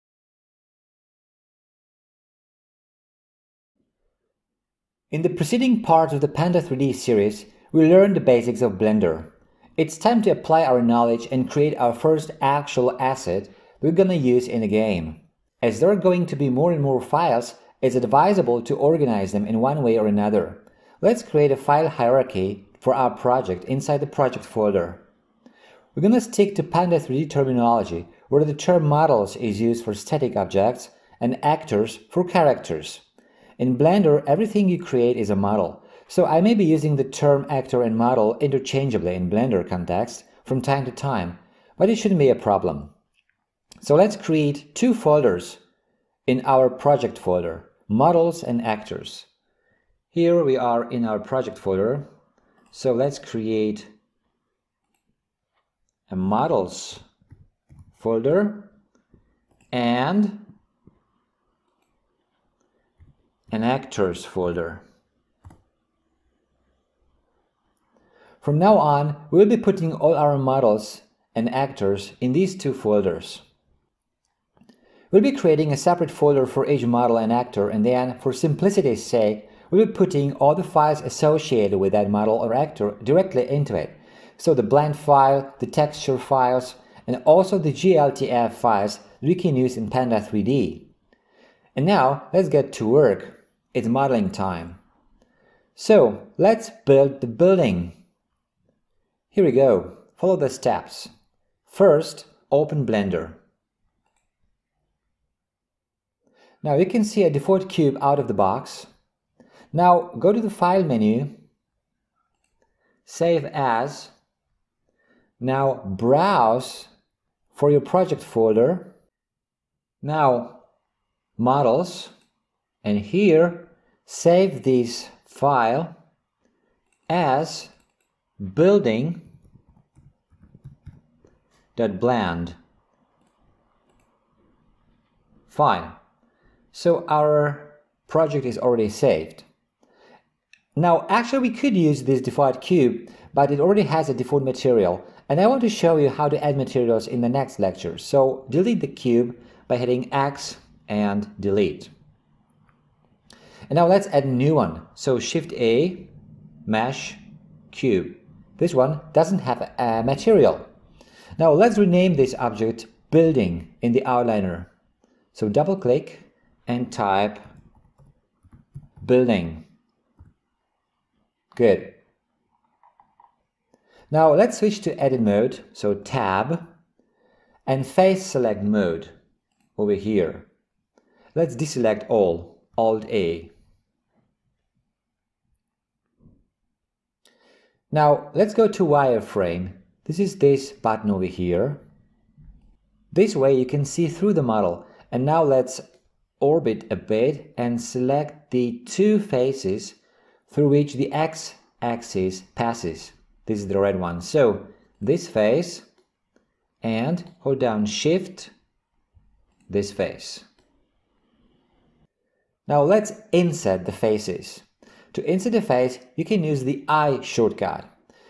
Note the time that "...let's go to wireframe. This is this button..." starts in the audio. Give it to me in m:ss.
3:08.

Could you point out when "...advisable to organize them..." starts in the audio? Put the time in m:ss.
0:17.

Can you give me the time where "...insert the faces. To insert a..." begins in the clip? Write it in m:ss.
3:33.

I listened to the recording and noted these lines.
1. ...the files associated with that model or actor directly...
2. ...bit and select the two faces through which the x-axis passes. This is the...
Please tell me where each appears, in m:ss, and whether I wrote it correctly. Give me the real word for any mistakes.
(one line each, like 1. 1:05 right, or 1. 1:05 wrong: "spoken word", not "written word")
1. 1:20 right
2. 3:16 right.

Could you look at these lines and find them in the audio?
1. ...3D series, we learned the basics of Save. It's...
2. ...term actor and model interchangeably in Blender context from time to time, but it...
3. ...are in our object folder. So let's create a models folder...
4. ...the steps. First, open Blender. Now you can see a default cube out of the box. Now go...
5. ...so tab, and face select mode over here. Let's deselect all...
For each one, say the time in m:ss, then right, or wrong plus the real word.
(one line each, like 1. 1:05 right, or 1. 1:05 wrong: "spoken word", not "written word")
1. 0:06 wrong: "Blender", not "Save"
2. 0:37 right
3. 0:50 wrong: "project", not "object"
4. 1:40 right
5. 2:55 right.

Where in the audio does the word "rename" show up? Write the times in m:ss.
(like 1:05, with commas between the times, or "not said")
2:41.